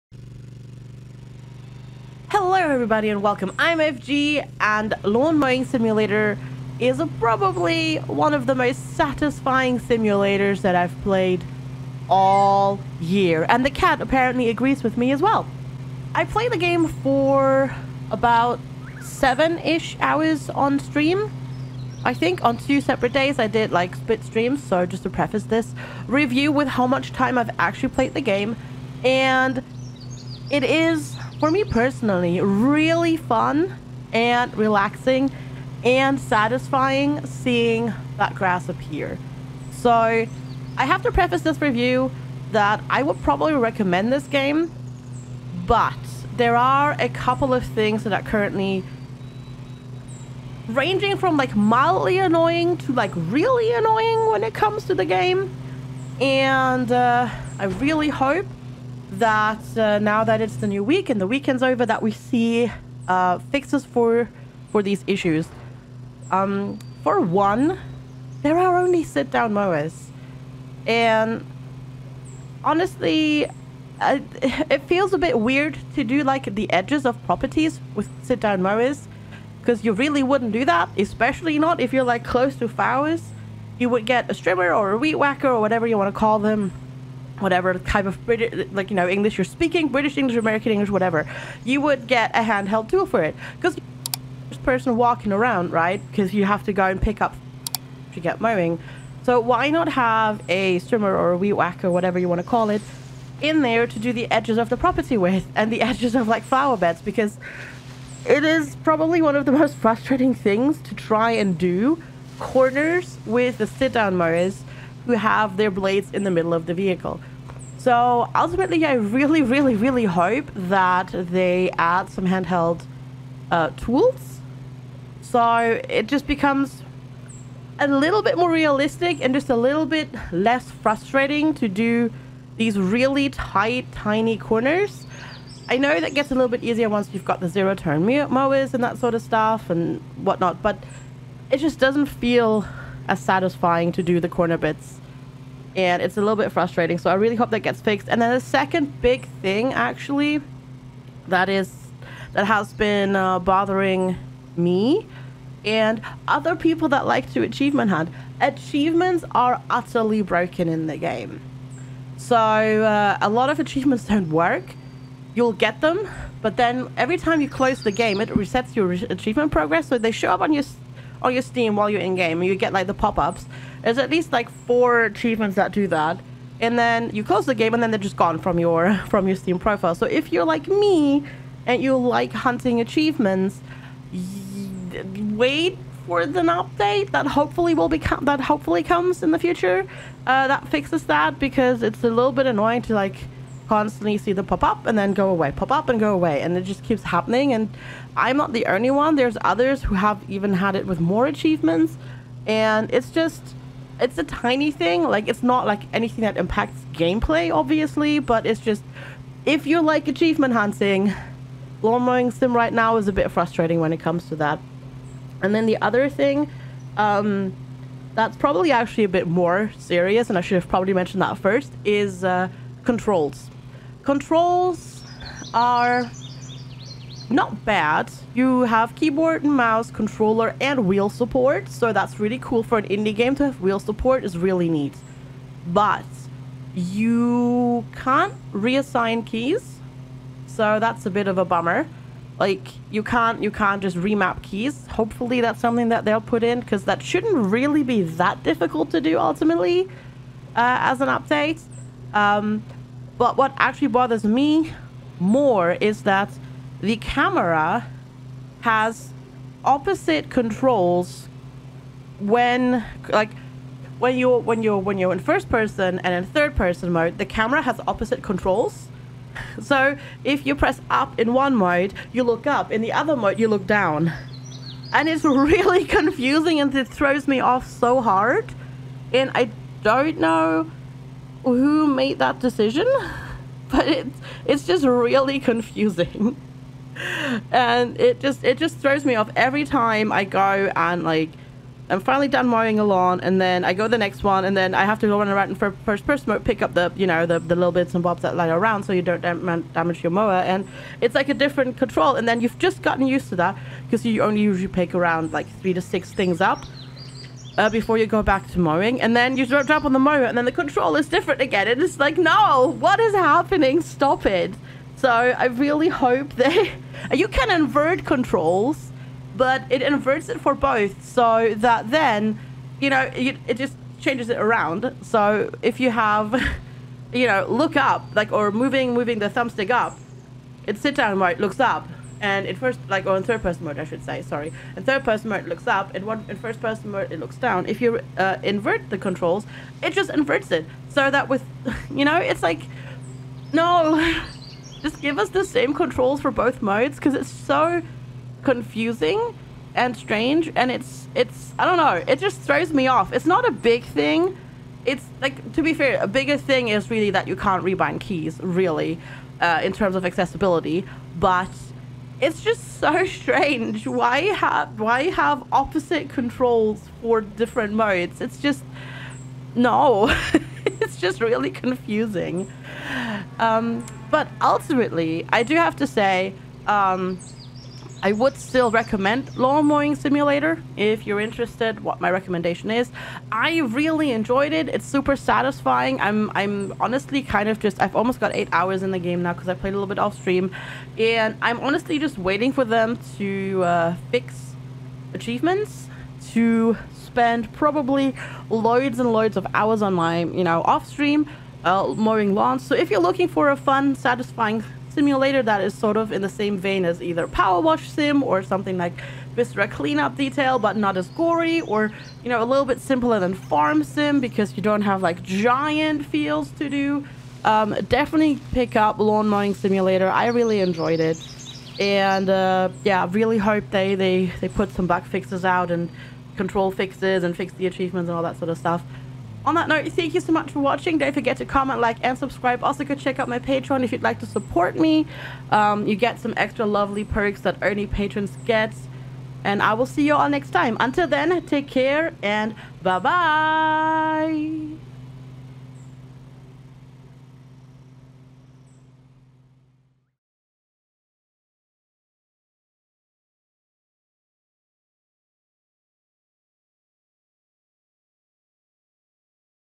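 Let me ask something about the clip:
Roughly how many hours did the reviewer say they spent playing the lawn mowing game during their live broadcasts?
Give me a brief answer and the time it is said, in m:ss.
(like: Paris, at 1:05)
7, at 0:19.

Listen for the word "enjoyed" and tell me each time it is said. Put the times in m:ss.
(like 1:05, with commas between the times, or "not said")
6:24, 7:00.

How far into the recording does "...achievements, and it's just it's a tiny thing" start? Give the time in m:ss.
3:21.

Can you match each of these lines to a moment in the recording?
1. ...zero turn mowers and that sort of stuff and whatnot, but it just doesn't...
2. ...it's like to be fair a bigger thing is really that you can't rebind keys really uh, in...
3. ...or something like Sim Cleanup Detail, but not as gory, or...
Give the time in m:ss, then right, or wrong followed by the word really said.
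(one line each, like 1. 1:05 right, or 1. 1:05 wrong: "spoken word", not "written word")
1. 2:17 right
2. 5:54 right
3. 6:48 wrong: "Viscera", not "Sim".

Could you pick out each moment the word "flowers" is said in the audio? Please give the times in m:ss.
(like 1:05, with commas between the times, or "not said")
1:22, 1:46.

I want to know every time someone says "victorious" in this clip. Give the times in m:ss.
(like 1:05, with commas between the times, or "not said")
not said.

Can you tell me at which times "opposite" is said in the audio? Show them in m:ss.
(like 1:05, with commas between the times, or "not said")
4:19, 4:27, 6:05.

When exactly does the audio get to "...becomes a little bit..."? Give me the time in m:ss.
2:06.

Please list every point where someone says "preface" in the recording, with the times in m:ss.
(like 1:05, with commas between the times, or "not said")
0:25, 0:41.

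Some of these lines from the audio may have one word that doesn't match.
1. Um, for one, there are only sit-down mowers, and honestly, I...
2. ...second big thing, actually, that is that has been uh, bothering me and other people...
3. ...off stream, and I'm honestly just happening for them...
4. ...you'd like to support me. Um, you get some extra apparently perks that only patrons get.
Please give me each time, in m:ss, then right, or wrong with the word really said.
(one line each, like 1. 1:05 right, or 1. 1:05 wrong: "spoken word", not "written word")
1. 1:06 right
2. 2:28 right
3. 6:29 wrong: "waiting", not "happening"
4. 7:13 wrong: "lovely", not "apparently".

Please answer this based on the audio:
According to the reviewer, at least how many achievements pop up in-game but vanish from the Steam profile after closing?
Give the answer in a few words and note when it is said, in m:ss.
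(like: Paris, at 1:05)
4, at 2:54.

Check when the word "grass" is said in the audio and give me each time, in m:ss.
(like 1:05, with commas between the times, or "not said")
0:38.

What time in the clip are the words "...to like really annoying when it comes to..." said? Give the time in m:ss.
0:52.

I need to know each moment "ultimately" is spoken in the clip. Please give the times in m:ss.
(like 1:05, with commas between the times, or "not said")
1:58, 4:09, 6:14.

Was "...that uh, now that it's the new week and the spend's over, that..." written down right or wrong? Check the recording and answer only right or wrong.
wrong.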